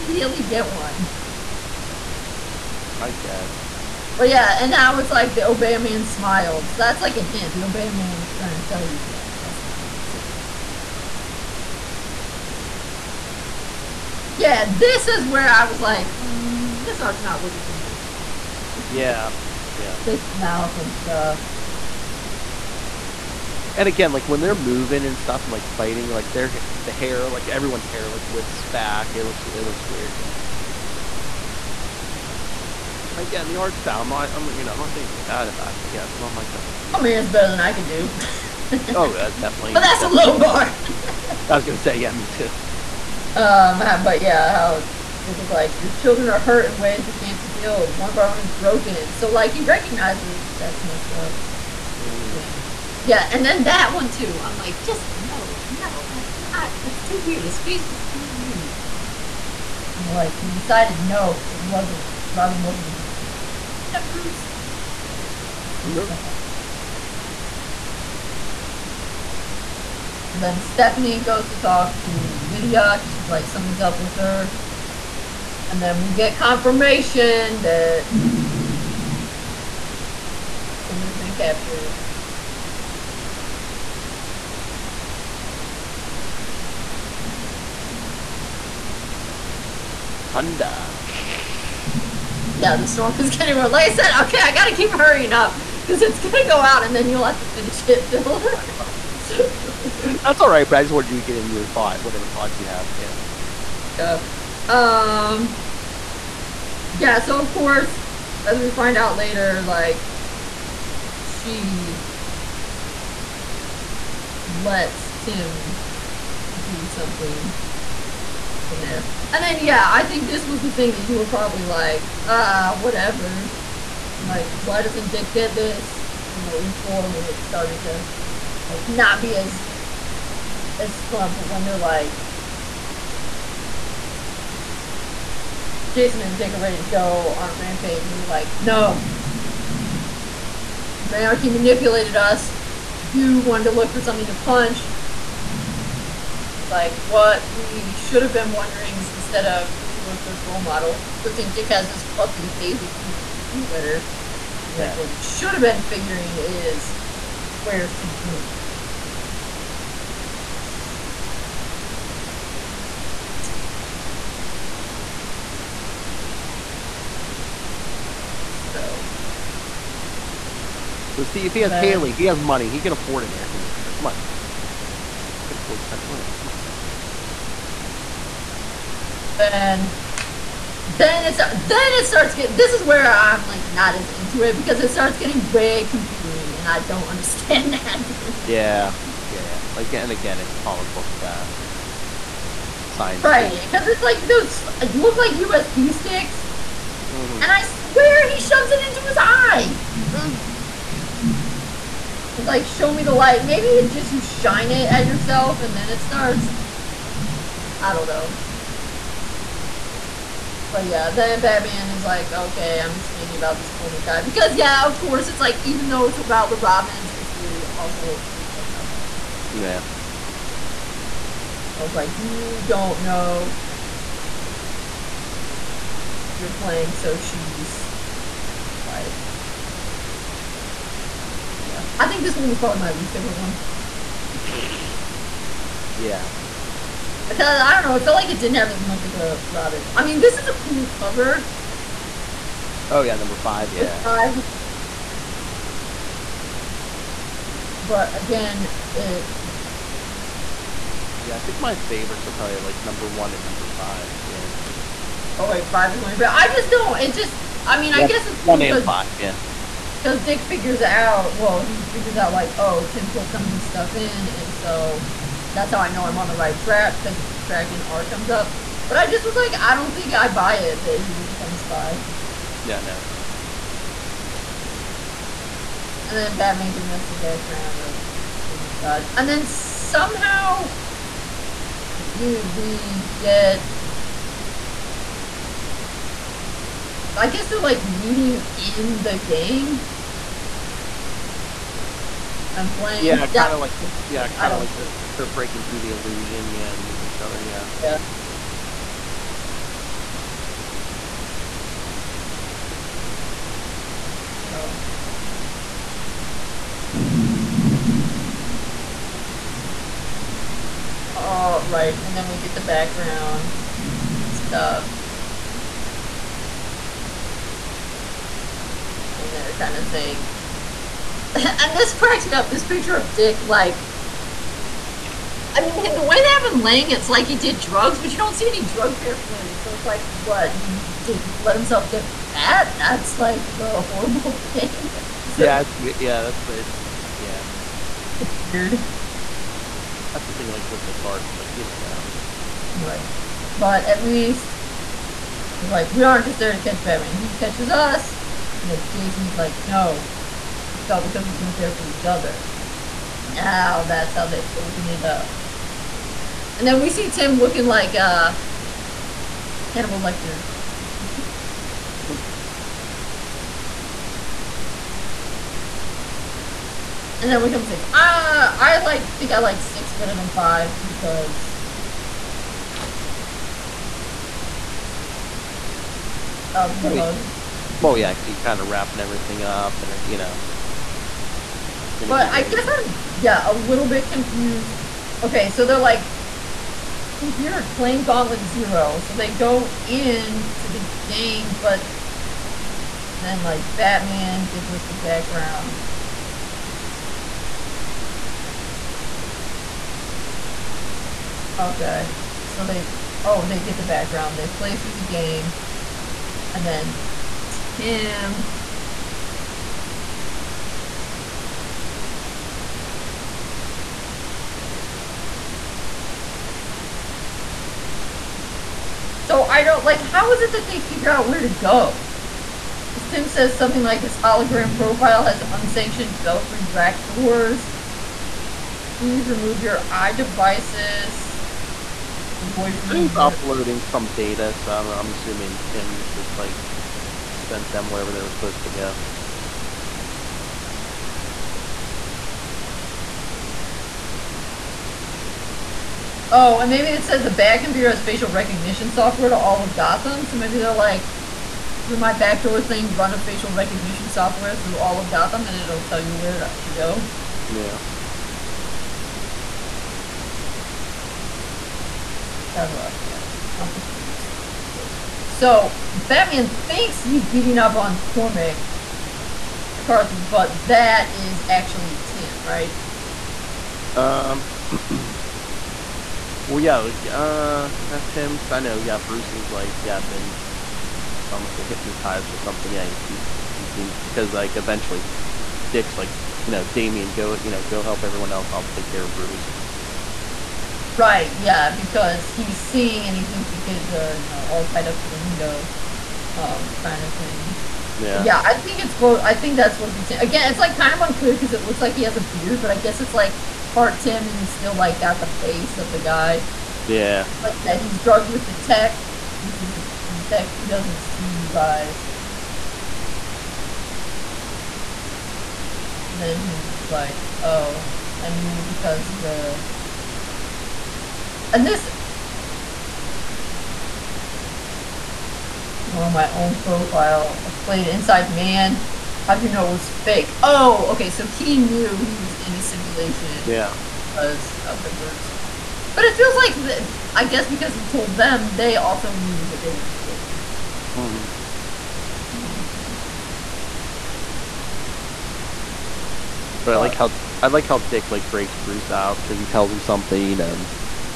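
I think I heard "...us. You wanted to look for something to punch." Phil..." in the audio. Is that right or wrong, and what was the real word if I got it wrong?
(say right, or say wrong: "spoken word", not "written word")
wrong: "And", not "Phil".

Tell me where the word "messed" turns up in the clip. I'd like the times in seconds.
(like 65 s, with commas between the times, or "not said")
50 s.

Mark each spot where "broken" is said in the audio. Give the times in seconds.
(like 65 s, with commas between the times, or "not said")
48 s.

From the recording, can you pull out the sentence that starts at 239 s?
I mean, this is a cool cover.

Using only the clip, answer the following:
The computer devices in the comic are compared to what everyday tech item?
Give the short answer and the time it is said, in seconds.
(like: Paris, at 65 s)
USB sticks, at 195 s.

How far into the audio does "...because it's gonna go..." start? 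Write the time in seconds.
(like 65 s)
95 s.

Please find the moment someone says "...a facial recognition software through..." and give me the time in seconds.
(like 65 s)
453 s.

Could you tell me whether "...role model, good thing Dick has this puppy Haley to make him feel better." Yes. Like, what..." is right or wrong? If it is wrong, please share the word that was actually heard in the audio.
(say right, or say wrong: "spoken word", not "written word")
right.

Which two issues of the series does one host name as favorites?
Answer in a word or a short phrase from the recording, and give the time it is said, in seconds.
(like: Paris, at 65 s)
1 and 5, at 252 s.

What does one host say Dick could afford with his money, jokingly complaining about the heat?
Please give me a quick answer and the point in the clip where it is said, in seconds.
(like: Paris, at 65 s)
Central Air, at 175 s.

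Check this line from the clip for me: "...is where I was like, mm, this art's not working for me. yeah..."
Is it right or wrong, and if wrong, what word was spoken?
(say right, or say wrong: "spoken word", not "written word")
right.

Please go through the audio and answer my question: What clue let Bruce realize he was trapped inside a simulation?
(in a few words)
The bird song.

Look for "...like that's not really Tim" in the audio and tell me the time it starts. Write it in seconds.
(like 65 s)
9 s.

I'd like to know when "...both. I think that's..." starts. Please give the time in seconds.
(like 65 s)
498 s.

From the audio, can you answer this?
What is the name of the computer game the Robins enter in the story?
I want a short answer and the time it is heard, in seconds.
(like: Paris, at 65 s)
Gauntlet Zero, at 388 s.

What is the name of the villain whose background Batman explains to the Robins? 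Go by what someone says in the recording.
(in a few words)
Cormac Dodge.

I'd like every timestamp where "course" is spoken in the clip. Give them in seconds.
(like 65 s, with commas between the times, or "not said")
107 s, 214 s.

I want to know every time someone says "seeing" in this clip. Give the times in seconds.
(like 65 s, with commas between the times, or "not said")
492 s.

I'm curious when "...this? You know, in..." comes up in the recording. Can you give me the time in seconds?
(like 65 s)
125 s.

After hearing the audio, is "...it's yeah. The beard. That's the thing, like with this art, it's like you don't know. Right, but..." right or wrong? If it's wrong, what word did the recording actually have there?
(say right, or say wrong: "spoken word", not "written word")
right.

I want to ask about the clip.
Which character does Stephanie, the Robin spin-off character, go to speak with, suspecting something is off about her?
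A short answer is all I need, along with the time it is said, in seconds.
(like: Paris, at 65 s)
Lydia, at 72 s.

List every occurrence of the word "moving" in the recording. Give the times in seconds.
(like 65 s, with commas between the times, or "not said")
24 s.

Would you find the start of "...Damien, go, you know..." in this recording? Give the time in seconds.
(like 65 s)
486 s.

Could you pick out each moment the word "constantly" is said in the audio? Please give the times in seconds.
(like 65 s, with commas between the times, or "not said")
not said.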